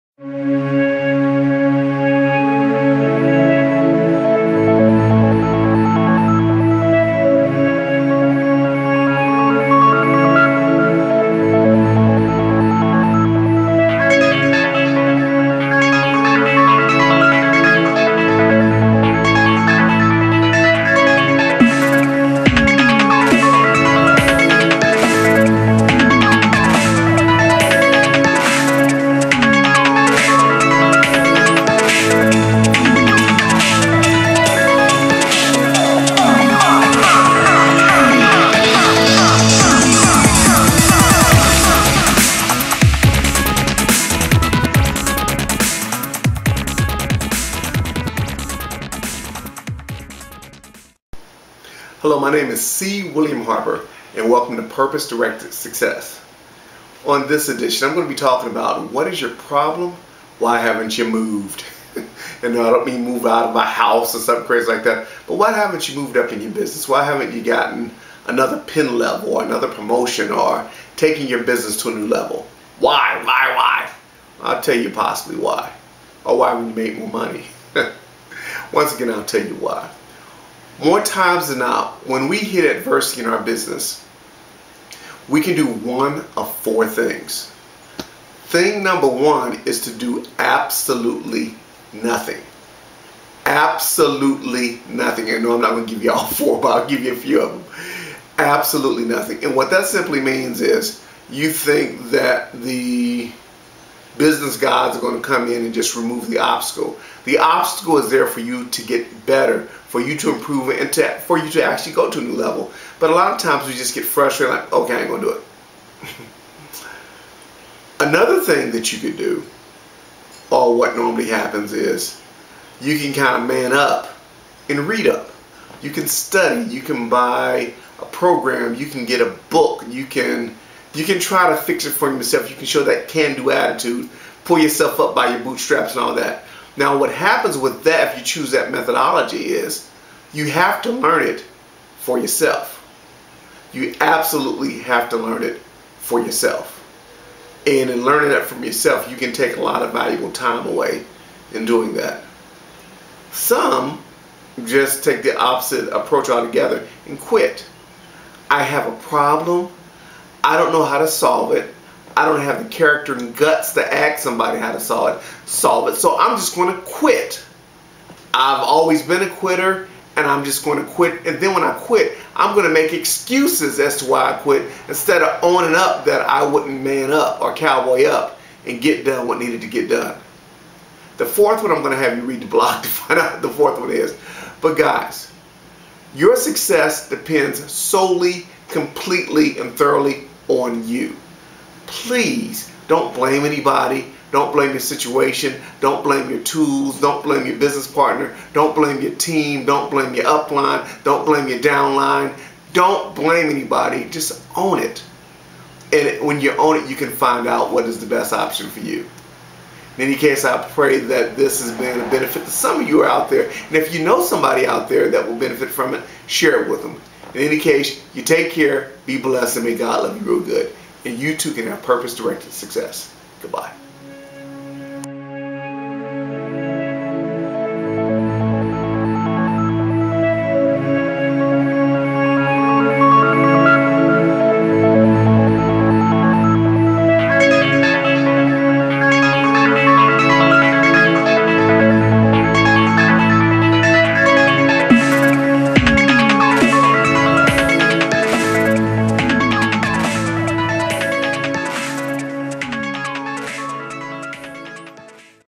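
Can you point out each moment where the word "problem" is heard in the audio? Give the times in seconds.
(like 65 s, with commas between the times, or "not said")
59 s, 158 s.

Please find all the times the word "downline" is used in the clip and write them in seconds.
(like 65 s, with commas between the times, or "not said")
201 s.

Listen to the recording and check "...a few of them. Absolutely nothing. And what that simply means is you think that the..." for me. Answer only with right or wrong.
right.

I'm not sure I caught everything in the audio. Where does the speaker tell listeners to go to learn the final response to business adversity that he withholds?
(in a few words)
the blog.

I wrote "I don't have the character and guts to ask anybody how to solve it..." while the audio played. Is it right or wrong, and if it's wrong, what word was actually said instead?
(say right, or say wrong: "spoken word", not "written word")
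wrong: "somebody", not "anybody".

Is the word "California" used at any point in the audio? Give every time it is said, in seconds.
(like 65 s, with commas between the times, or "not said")
not said.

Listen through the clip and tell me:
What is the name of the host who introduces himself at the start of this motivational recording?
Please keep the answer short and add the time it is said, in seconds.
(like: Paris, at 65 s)
C. William Harper, at 52 s.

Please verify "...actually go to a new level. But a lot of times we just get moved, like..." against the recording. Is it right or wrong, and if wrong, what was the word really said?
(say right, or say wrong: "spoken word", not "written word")
wrong: "frustrated", not "moved".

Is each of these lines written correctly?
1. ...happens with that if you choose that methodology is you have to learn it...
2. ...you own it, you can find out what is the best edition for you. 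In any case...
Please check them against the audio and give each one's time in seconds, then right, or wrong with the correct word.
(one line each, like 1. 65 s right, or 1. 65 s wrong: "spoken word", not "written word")
1. 137 s right
2. 206 s wrong: "option", not "edition".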